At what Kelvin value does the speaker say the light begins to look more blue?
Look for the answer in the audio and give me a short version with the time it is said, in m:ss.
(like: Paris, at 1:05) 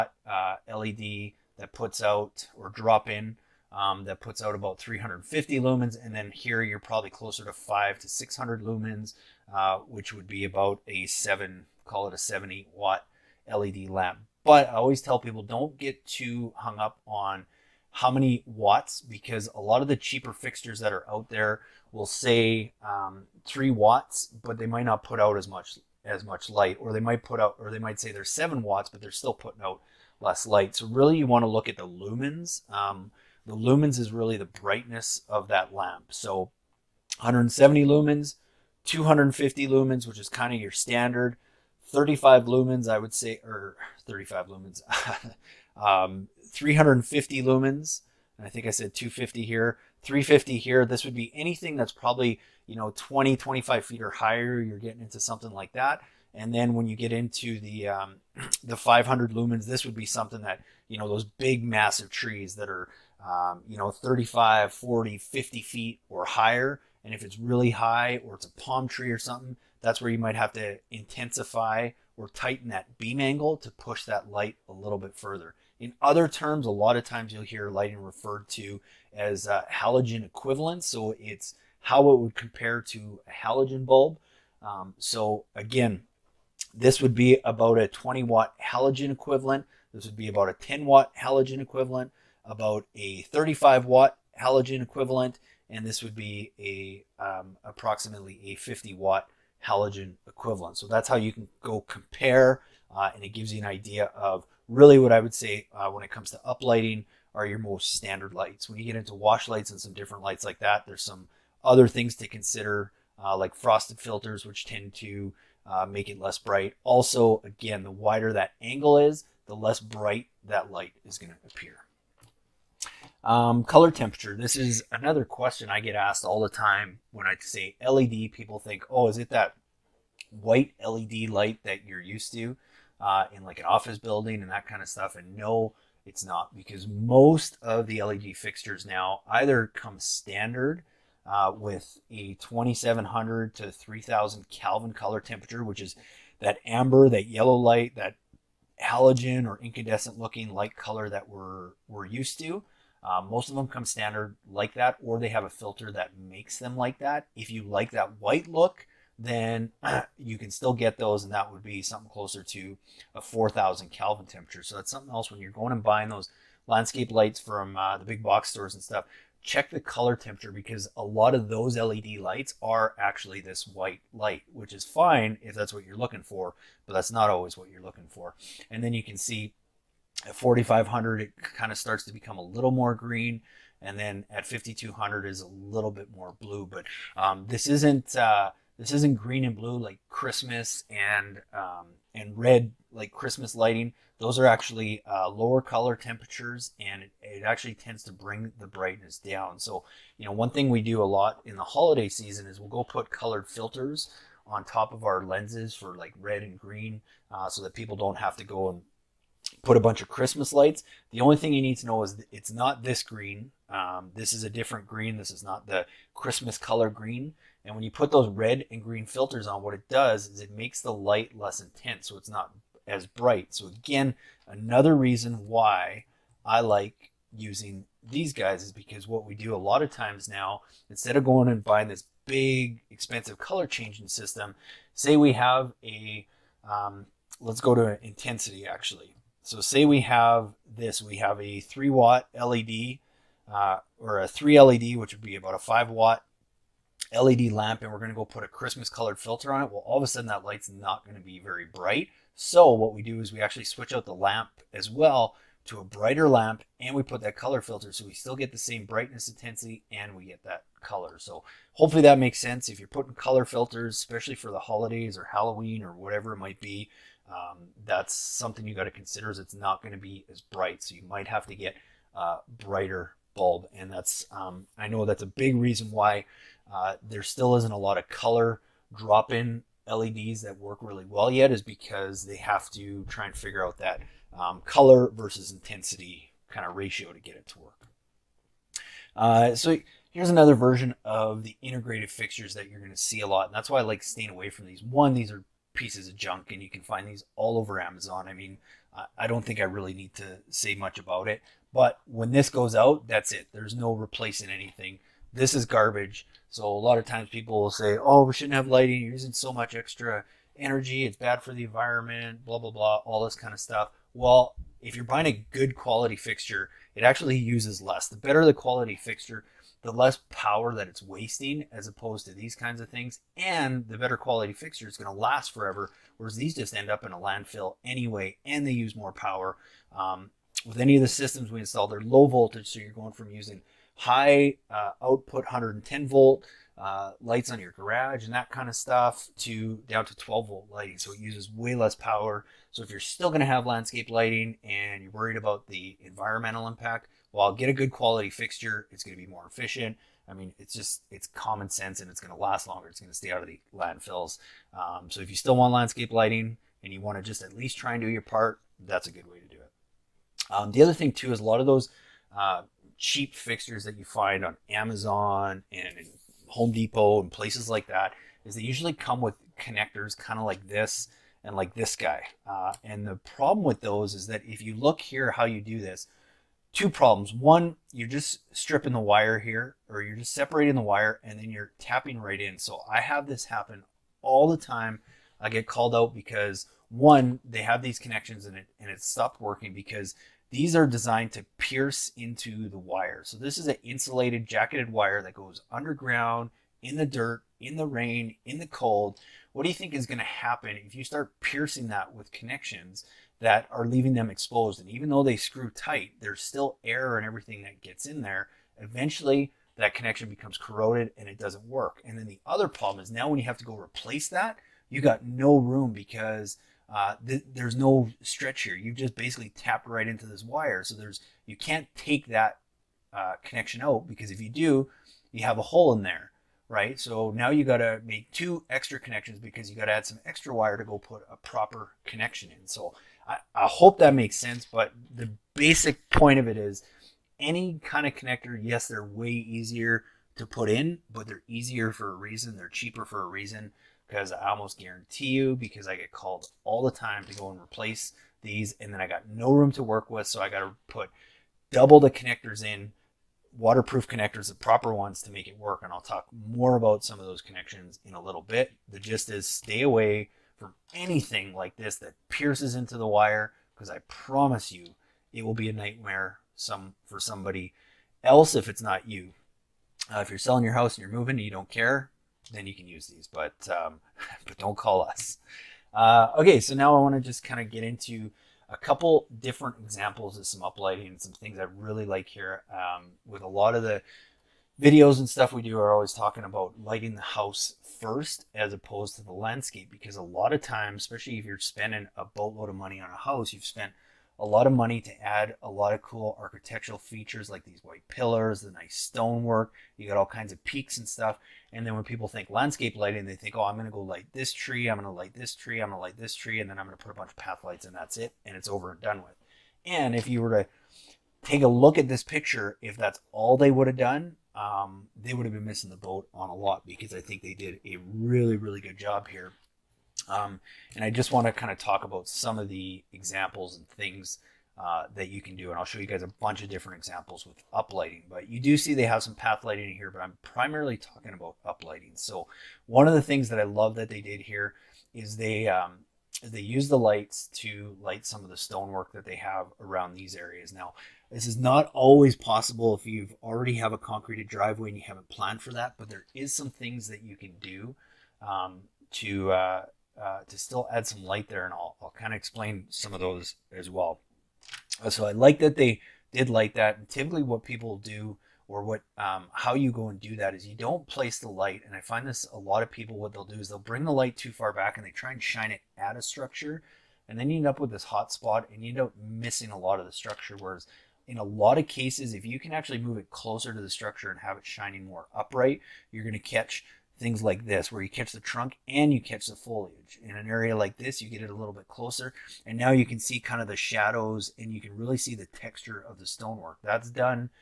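5200, at 3:04.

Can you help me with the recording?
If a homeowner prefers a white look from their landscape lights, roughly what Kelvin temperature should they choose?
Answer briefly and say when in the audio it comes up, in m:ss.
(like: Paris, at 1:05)
4,000 Kelvin, at 2:43.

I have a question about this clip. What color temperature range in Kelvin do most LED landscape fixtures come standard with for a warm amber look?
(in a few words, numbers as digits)
2700 to 3000 Kelvin.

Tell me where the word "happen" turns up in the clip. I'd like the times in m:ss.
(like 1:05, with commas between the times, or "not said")
6:23, 6:40.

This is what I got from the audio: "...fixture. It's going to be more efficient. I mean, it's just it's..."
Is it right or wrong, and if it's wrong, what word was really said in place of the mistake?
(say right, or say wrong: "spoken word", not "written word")
right.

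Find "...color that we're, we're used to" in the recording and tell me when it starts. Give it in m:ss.
2:30.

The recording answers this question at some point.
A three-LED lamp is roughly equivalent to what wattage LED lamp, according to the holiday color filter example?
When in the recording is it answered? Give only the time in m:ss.
4:05.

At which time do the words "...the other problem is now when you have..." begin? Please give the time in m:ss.
6:52.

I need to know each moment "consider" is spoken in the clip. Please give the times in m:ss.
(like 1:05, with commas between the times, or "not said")
1:52, 4:28.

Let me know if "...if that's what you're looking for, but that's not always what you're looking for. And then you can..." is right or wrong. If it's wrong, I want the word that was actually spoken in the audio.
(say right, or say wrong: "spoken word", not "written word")
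right.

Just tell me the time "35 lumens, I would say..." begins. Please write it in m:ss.
0:41.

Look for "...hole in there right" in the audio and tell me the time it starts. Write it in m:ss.
7:05.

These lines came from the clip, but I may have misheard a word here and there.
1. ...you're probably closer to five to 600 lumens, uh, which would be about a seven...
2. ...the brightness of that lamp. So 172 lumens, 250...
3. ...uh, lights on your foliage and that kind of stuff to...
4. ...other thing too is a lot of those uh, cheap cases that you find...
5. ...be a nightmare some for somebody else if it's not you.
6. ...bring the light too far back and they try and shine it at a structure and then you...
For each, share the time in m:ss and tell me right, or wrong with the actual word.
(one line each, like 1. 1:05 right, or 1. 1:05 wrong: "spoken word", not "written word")
1. 0:06 right
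2. 0:34 wrong: "170", not "172"
3. 5:36 wrong: "garage", not "foliage"
4. 6:00 wrong: "fixtures", not "cases"
5. 7:45 right
6. 9:23 right.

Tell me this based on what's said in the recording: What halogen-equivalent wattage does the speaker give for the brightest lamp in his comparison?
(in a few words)
50 watt.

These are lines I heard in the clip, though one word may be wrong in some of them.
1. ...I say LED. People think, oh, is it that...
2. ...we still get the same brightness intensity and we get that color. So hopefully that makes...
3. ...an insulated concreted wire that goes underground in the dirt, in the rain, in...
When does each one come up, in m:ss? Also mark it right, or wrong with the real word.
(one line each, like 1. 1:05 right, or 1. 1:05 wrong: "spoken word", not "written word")
1. 2:07 right
2. 4:18 right
3. 6:33 wrong: "jacketed", not "concreted".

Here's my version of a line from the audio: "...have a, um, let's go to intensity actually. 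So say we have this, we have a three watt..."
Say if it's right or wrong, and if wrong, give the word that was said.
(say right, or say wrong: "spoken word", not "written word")
right.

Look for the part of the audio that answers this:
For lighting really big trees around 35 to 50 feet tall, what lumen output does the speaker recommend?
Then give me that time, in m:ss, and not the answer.
0:58.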